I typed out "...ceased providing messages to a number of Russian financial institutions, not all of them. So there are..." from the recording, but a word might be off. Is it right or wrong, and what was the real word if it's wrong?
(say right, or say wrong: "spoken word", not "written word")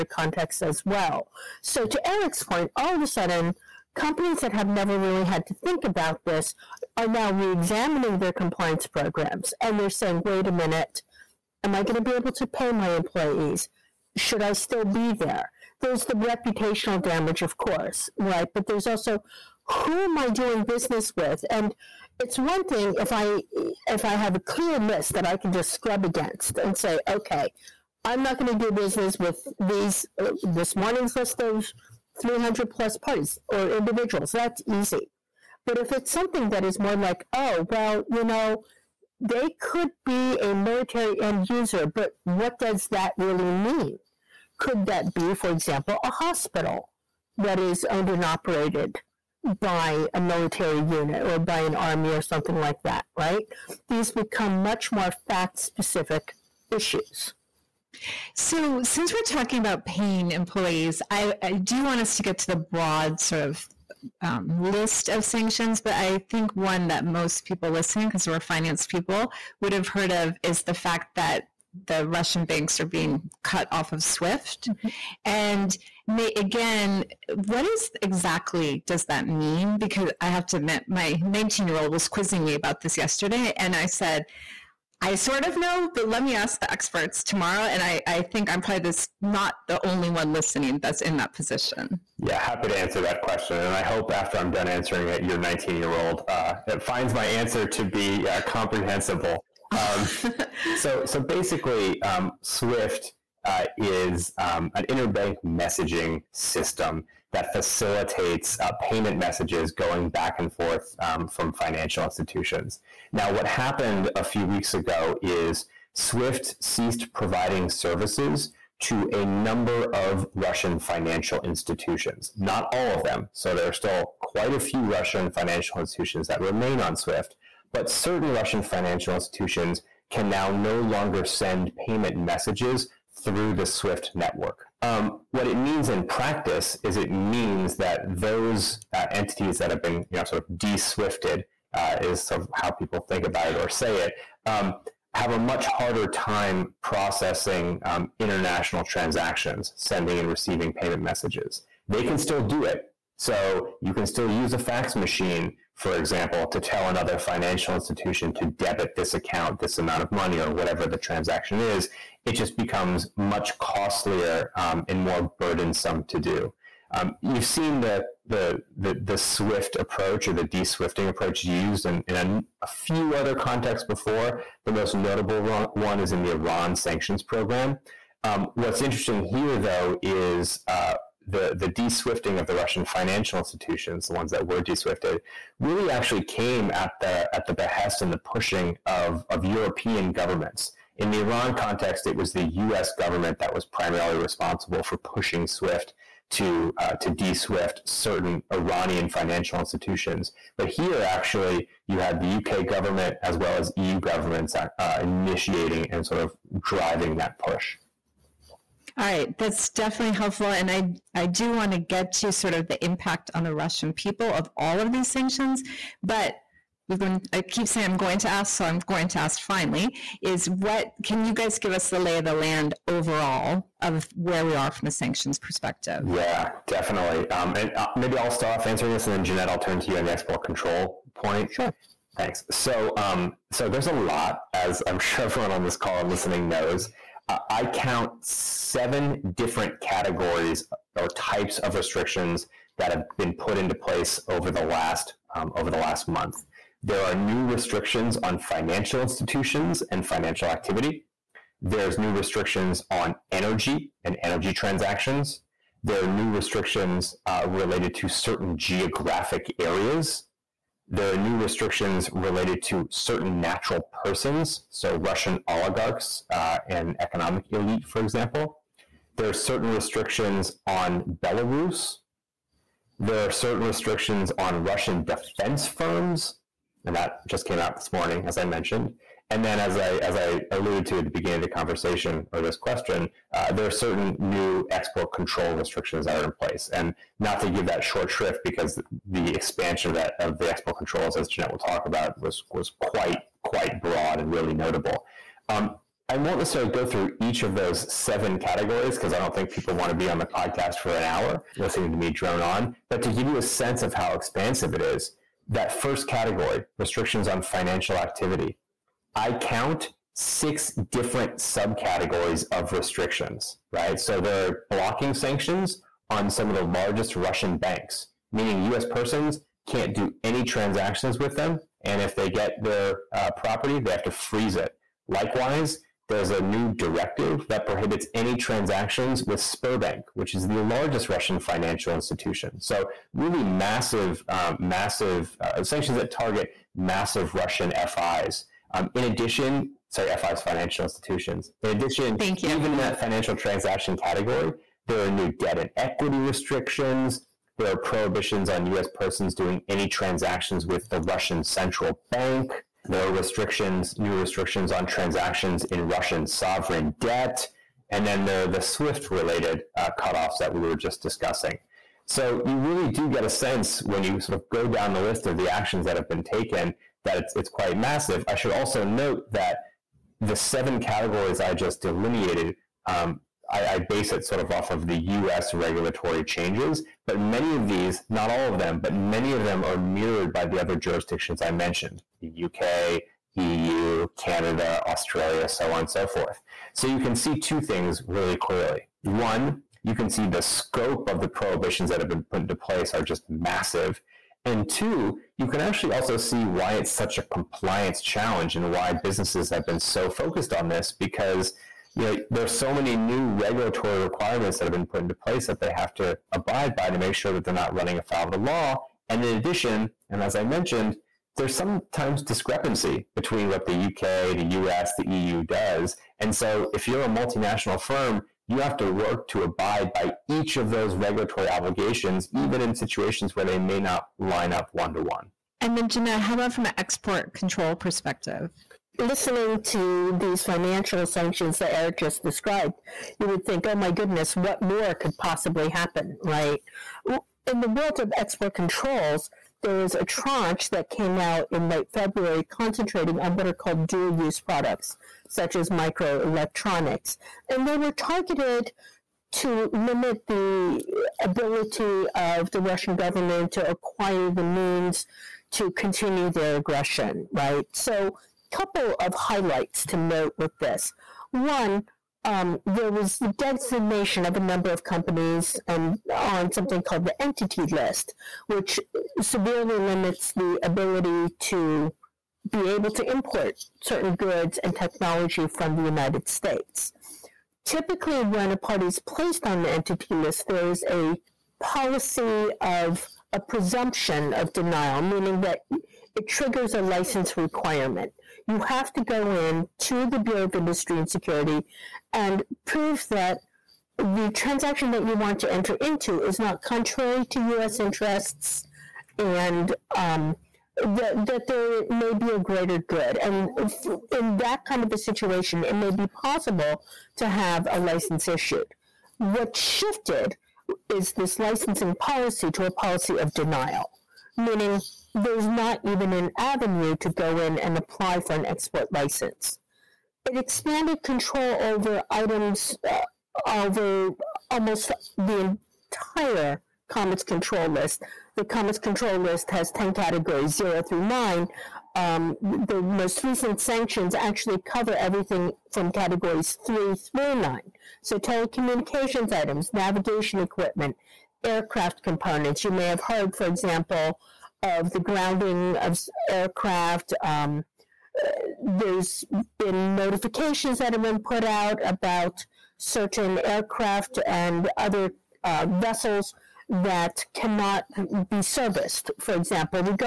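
wrong: "services", not "messages".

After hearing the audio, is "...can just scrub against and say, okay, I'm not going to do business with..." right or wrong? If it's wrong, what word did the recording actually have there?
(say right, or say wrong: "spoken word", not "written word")
right.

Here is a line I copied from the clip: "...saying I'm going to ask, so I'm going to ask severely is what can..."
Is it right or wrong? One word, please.
wrong.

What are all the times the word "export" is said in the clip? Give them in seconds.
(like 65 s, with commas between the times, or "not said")
230 s, 284 s, 290 s, 426 s, 438 s, 518 s.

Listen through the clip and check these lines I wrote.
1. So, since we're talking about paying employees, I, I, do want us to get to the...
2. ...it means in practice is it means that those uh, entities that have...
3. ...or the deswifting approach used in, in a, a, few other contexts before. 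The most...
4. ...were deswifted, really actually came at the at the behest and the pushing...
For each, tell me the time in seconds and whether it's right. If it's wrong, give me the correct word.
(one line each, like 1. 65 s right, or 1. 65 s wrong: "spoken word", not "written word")
1. 58 s right
2. 135 s right
3. 170 s right
4. 184 s right.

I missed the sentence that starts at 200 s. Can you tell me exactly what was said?
But here, actually, you had the UK government as well as EU governments uh, initiating and sort of driving that push.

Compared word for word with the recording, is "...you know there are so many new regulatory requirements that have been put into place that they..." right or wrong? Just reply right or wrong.
right.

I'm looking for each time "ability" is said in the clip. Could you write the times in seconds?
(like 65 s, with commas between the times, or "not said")
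451 s, 470 s.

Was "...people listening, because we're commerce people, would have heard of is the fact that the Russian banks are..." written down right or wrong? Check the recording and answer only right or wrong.
wrong.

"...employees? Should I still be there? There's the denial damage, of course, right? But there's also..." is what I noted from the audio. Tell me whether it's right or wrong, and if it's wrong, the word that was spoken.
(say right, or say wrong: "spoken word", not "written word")
wrong: "reputational", not "denial".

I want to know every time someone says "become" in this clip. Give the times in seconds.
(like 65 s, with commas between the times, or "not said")
54 s, 162 s.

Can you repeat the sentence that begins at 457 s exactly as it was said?
So, couple of highlights to note with this.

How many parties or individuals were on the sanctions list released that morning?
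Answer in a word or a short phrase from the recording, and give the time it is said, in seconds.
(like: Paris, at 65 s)
300 plus, at 32 s.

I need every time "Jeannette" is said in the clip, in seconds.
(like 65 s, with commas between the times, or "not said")
229 s, 291 s.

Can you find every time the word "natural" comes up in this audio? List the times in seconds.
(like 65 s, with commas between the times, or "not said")
263 s.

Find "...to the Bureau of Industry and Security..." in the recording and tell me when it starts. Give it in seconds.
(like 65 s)
489 s.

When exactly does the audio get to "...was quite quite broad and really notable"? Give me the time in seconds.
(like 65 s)
292 s.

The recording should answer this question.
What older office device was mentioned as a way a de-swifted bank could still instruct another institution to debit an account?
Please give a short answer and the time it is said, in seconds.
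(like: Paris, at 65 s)
fax machine, at 154 s.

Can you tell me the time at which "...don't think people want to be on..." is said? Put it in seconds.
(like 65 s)
299 s.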